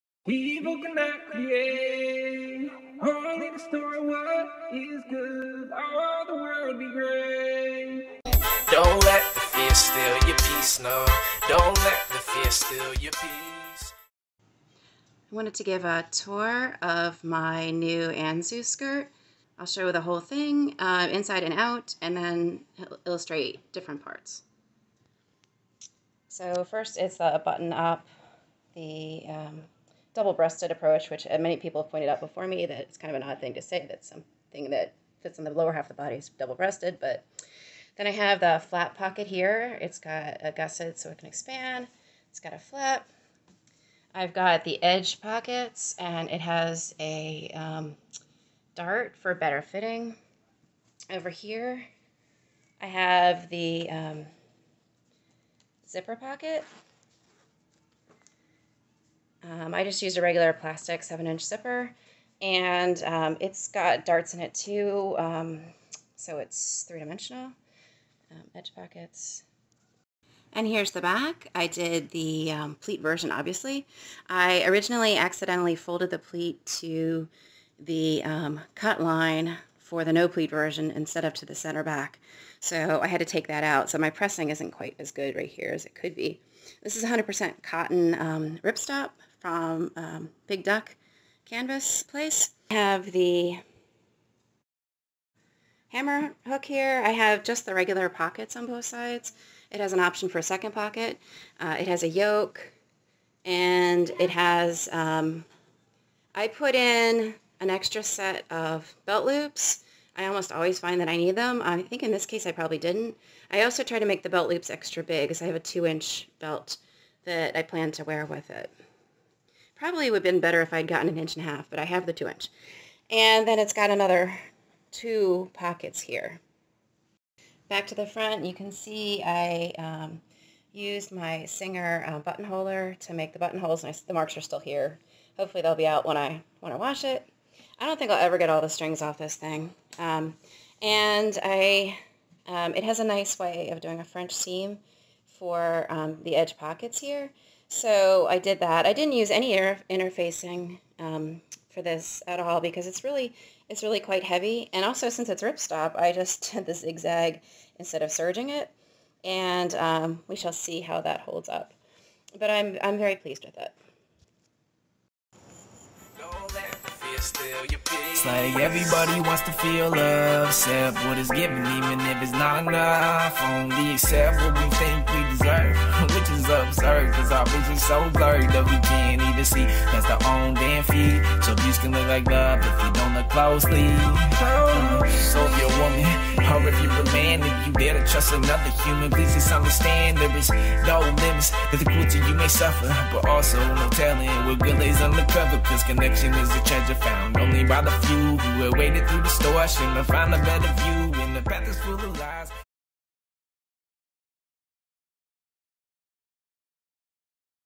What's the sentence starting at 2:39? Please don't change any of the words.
And um, we shall see how that holds up.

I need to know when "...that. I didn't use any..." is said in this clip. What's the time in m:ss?
2:28.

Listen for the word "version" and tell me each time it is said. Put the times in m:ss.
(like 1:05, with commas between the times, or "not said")
1:13, 1:20.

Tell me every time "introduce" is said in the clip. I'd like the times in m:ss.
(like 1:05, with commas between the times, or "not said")
not said.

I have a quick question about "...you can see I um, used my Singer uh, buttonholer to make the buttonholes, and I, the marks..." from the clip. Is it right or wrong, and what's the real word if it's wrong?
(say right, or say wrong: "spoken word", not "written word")
right.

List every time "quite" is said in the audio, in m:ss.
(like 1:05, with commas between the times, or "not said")
1:24, 2:34.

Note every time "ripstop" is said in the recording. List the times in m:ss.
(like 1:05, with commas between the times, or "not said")
1:28, 2:35.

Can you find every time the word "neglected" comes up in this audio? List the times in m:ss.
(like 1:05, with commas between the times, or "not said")
not said.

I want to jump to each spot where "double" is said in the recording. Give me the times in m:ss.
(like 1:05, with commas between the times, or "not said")
0:30, 0:36.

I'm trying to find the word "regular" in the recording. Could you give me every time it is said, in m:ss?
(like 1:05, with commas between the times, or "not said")
1:00, 1:37.